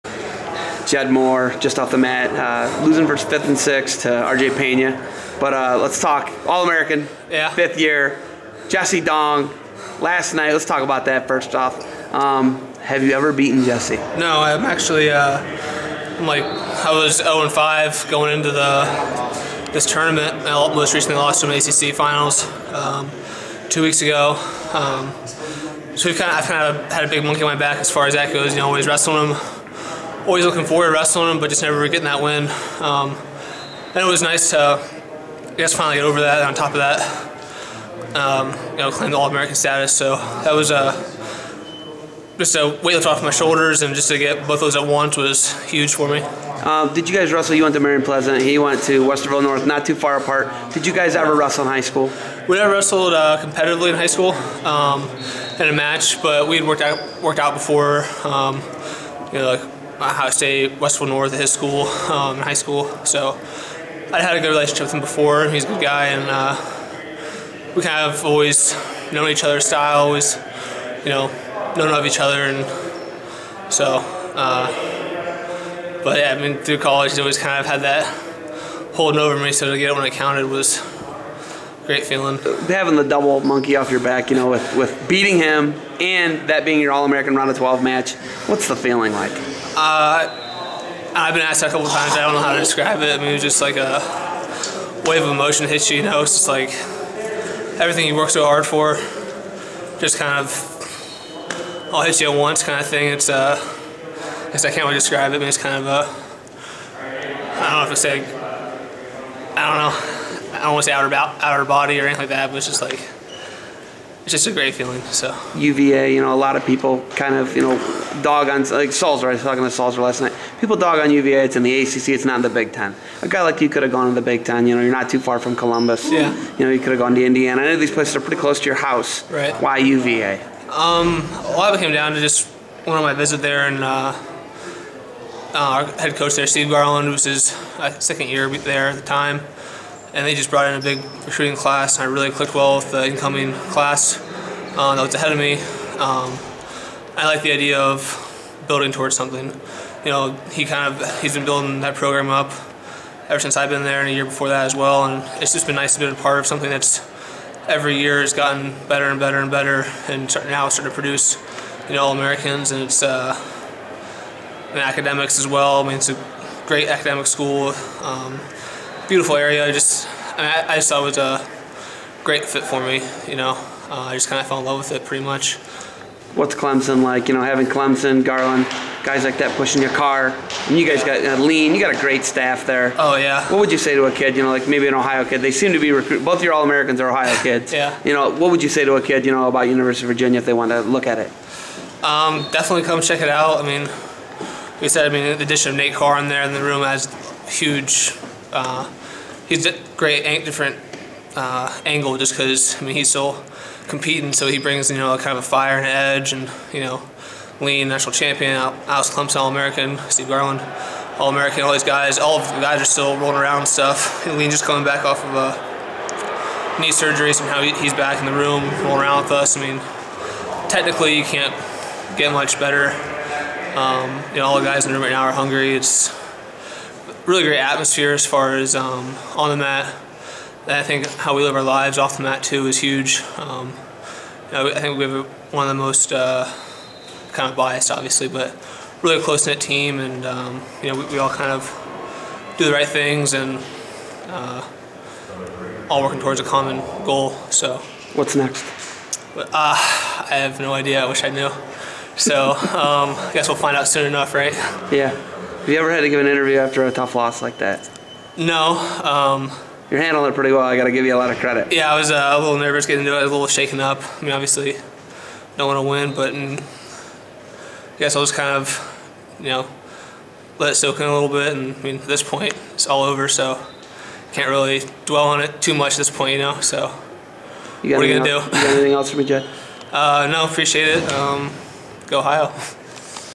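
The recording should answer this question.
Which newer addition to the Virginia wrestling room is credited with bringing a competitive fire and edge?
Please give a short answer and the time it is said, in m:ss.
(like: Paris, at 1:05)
Nate Carr, at 3:15.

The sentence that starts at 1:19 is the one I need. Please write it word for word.
So to get it when I counted was great feeling.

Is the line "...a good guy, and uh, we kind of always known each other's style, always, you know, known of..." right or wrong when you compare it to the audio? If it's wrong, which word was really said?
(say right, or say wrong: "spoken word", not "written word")
right.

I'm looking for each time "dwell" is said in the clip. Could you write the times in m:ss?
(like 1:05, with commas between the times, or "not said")
4:35.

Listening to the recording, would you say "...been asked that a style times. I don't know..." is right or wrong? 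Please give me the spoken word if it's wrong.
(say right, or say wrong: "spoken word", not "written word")
wrong: "couple", not "style".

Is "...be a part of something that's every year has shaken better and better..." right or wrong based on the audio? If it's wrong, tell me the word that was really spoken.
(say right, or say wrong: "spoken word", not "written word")
wrong: "gotten", not "shaken".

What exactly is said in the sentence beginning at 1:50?
I don't want to say outer, outer body or anything like that, but it's just like it's just a great feeling.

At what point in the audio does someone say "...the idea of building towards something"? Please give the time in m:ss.
2:27.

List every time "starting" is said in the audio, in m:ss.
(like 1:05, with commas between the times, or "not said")
2:40.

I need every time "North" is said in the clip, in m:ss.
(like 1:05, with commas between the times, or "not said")
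0:49, 1:01.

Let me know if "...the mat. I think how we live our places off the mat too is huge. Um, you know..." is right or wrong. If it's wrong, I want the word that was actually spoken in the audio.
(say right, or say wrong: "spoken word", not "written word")
wrong: "lives", not "places".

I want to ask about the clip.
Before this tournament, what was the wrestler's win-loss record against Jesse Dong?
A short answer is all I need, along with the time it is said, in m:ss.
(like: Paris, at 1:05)
0 and 5, at 0:17.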